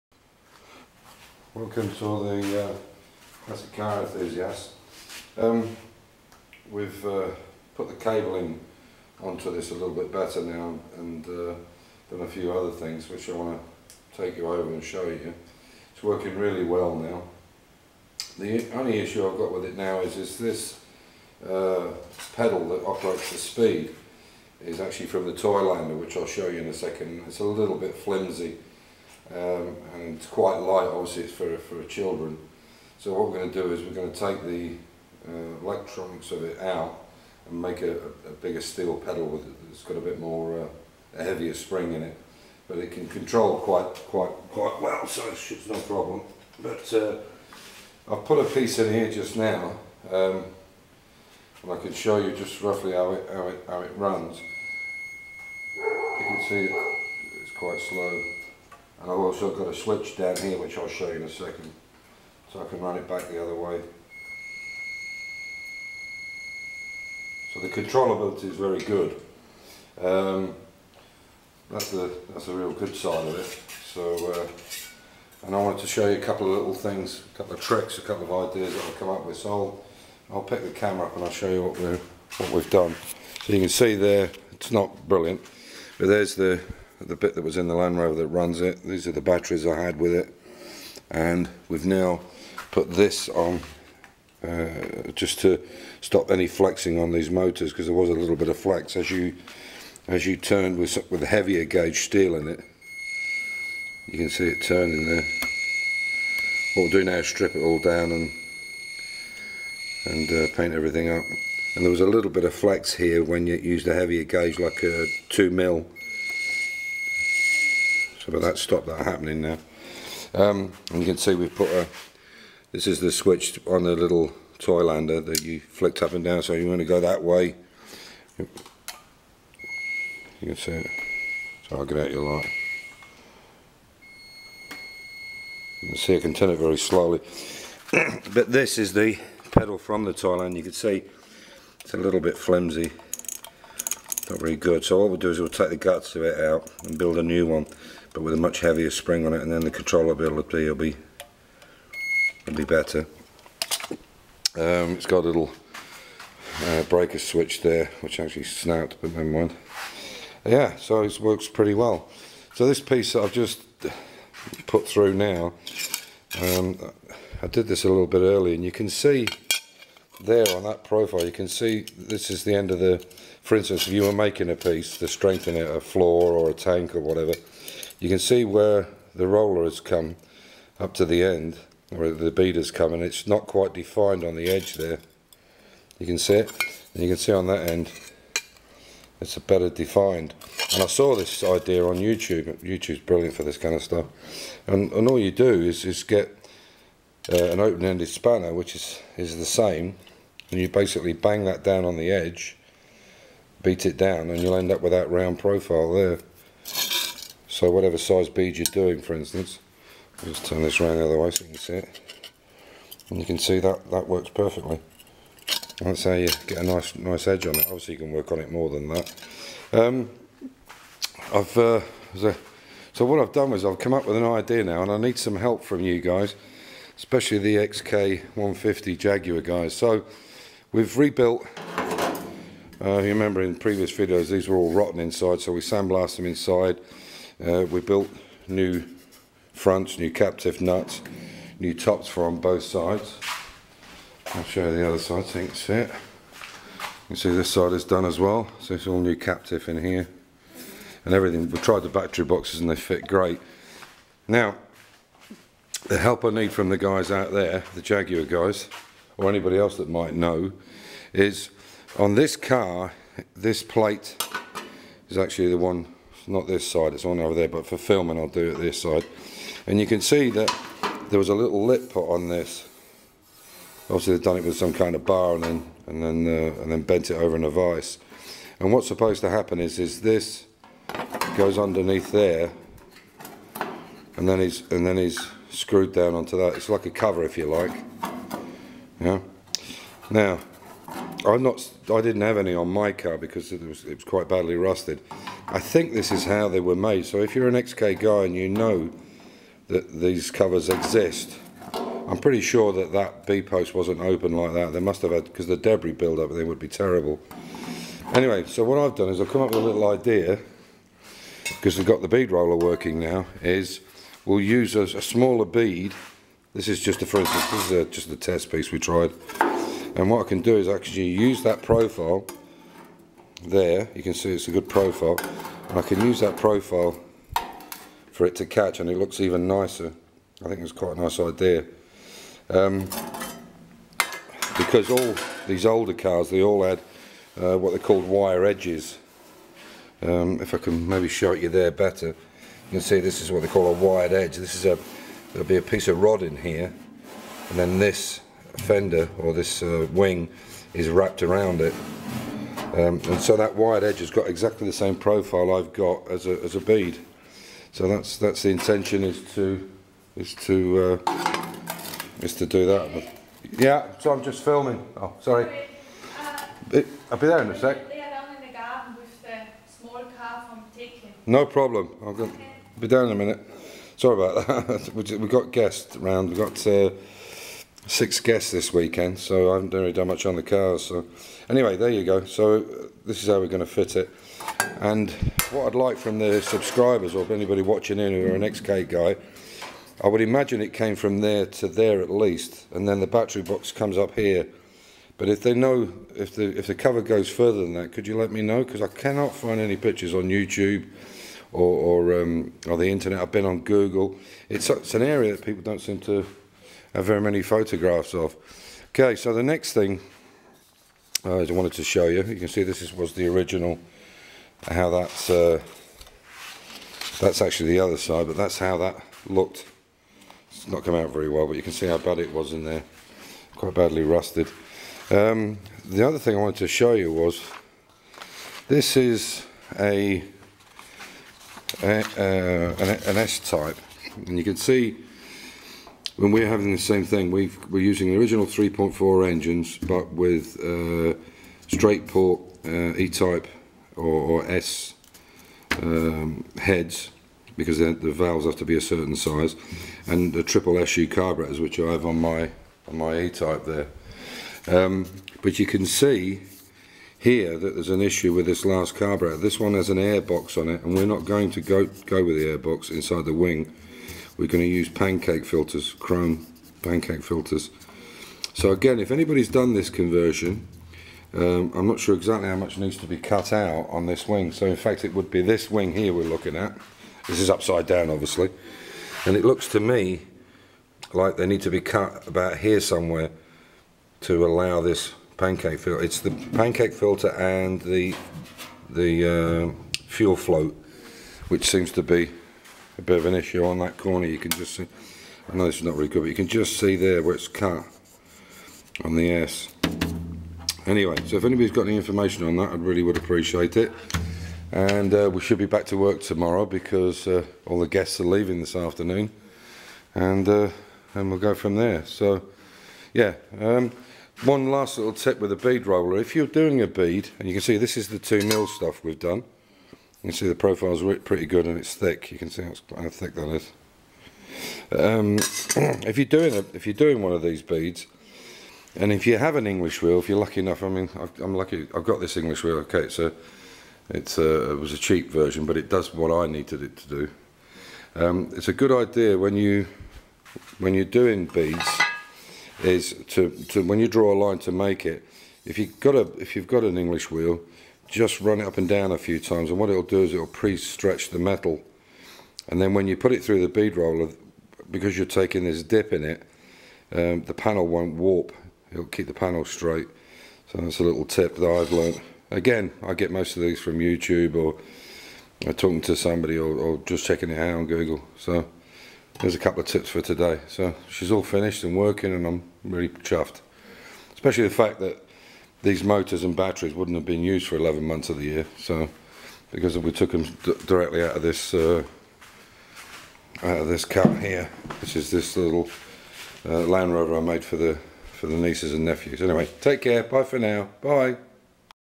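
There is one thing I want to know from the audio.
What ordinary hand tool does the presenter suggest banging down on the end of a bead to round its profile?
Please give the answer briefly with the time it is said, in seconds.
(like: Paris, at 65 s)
open-ended spanner, at 197 s.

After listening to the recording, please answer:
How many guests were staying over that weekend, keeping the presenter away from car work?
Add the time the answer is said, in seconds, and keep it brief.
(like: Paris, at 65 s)
6, at 377 s.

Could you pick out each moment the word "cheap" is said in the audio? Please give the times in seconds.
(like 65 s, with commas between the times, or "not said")
534 s.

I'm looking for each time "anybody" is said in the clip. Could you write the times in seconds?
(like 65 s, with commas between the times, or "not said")
259 s, 387 s, 469 s, 501 s.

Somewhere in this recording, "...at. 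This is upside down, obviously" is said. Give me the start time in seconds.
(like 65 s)
476 s.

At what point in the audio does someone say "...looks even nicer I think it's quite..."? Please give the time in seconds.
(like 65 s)
328 s.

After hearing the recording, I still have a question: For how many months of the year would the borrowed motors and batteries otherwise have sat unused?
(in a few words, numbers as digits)
11.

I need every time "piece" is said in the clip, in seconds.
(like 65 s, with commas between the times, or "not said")
48 s, 162 s, 174 s, 318 s, 345 s.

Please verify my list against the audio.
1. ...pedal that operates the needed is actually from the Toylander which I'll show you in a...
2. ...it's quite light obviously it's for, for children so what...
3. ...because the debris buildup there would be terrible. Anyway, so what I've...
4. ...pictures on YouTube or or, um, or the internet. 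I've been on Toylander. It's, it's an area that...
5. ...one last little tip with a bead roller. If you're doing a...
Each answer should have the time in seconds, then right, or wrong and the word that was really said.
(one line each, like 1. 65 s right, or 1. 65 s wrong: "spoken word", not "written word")
1. 22 s wrong: "speed", not "needed"
2. 30 s right
3. 305 s right
4. 399 s wrong: "Google", not "Toylander"
5. 514 s right.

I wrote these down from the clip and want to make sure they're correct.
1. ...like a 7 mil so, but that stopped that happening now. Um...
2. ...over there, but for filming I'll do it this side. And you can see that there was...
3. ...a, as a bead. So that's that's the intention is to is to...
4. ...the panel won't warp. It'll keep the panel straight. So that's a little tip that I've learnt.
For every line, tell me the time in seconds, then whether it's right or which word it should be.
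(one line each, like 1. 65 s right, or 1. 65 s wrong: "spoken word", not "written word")
1. 114 s wrong: "2", not "7"
2. 267 s right
3. 356 s right
4. 557 s right.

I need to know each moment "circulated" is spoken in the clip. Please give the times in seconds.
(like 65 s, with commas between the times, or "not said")
not said.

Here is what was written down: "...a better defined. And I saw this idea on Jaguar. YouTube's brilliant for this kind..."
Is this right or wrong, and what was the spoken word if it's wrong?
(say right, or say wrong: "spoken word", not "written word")
wrong: "YouTube", not "Jaguar".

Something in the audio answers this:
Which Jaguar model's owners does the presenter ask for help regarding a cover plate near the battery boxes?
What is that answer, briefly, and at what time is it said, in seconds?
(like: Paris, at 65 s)
XK150, at 227 s.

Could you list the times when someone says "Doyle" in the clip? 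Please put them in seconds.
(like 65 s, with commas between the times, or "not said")
not said.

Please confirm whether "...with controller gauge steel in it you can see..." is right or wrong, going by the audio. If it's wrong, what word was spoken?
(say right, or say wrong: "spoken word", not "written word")
wrong: "heavier", not "controller".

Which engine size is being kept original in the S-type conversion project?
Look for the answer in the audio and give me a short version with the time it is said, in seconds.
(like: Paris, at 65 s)
3.4, at 438 s.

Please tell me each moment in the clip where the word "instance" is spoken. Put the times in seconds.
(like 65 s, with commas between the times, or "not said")
173 s, 209 s, 317 s.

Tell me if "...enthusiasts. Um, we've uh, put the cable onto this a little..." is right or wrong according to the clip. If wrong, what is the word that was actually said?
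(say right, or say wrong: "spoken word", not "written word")
right.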